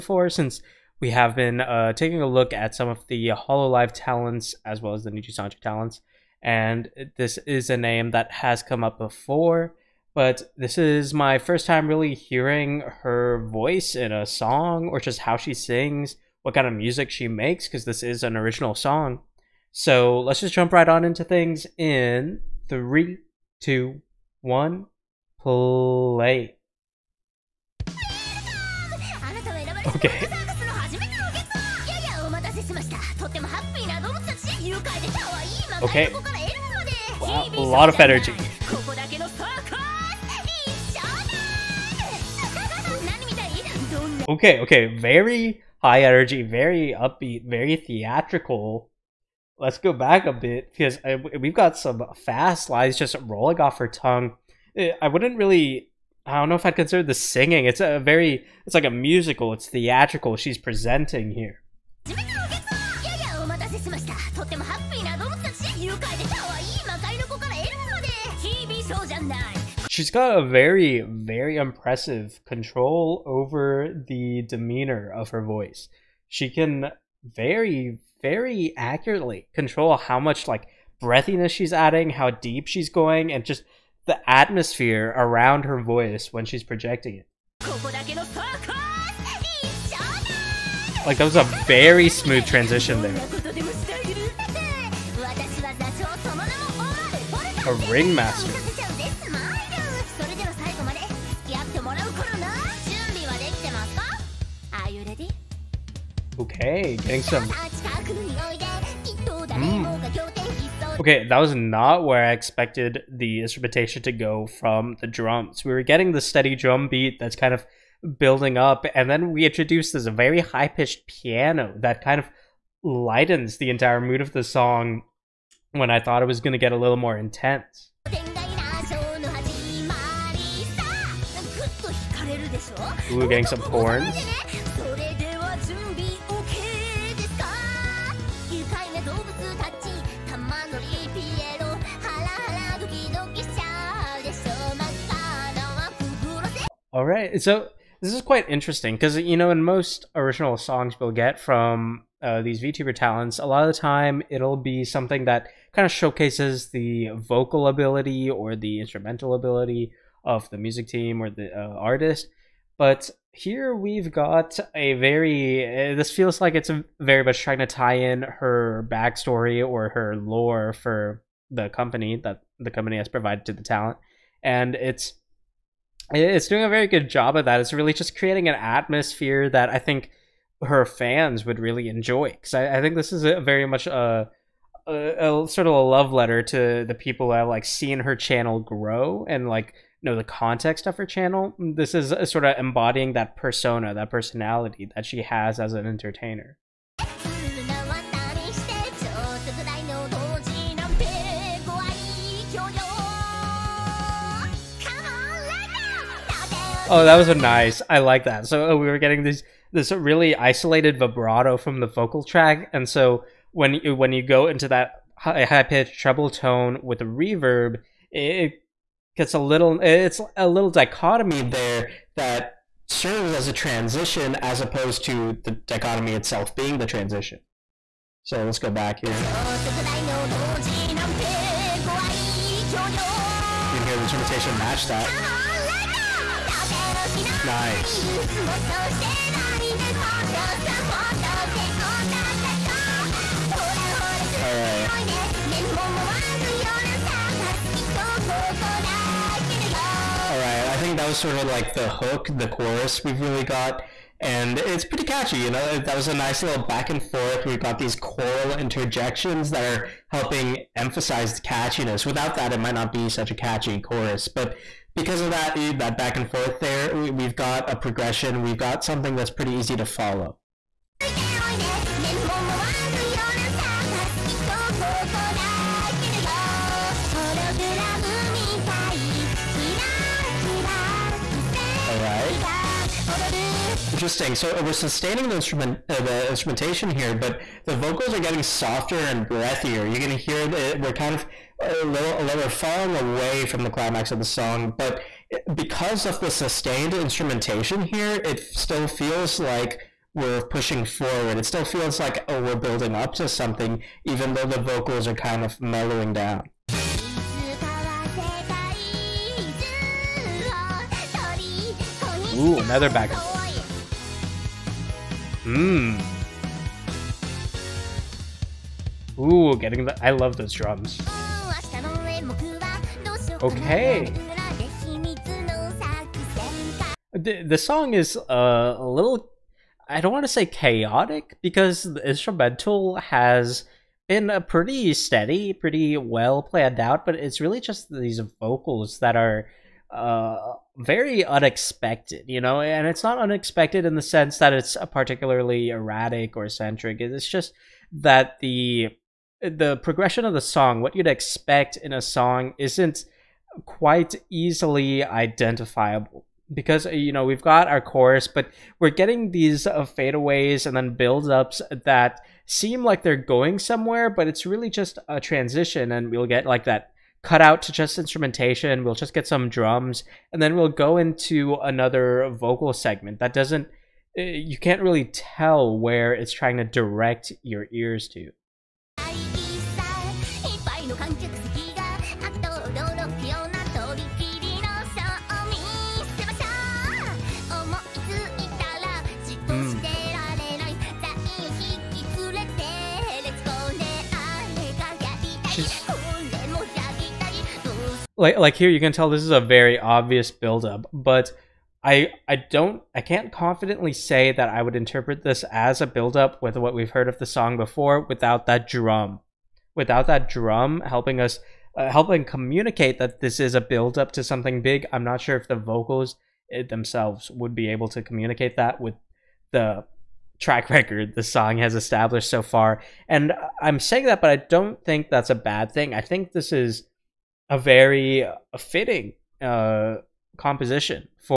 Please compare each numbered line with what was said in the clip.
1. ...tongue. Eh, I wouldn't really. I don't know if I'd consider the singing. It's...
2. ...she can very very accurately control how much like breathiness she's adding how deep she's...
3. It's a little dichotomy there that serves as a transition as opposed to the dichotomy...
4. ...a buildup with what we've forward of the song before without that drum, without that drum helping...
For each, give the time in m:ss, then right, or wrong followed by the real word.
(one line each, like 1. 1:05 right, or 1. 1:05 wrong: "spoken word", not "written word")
1. 0:53 right
2. 1:16 right
3. 3:39 right
4. 6:45 wrong: "heard", not "forward".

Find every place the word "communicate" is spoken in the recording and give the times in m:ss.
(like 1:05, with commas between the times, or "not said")
6:52, 6:58.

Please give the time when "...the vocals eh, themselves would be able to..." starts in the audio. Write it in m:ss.
6:55.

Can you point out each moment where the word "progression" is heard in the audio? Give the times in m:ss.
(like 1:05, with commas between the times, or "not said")
4:27, 5:49.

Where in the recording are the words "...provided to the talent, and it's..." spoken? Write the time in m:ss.
2:53.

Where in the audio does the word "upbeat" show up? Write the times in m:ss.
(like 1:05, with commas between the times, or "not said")
0:46.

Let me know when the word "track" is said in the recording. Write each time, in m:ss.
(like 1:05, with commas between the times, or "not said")
3:32, 7:00.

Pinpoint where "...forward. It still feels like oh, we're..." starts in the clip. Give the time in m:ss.
5:00.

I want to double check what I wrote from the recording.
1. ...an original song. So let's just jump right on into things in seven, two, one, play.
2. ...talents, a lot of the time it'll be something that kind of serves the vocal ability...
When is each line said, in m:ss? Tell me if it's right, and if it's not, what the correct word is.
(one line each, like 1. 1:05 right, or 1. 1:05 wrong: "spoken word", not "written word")
1. 0:18 wrong: "three", not "seven"
2. 2:32 wrong: "showcases", not "serves".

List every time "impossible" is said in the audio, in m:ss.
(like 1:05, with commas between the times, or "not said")
not said.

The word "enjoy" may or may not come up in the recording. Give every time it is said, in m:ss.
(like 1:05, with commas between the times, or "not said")
3:01.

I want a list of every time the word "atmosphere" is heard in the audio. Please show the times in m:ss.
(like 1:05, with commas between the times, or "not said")
1:24, 2:58.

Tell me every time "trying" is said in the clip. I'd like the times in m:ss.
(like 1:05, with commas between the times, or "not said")
2:47, 6:16.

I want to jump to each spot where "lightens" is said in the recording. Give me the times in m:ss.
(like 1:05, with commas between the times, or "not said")
2:02.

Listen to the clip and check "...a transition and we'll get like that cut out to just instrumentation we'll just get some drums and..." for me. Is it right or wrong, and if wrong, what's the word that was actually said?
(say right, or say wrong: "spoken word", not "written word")
right.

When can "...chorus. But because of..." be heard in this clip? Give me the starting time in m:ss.
4:23.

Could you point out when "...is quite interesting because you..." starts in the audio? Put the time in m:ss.
2:28.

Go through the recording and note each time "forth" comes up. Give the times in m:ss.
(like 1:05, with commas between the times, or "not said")
4:17, 4:26.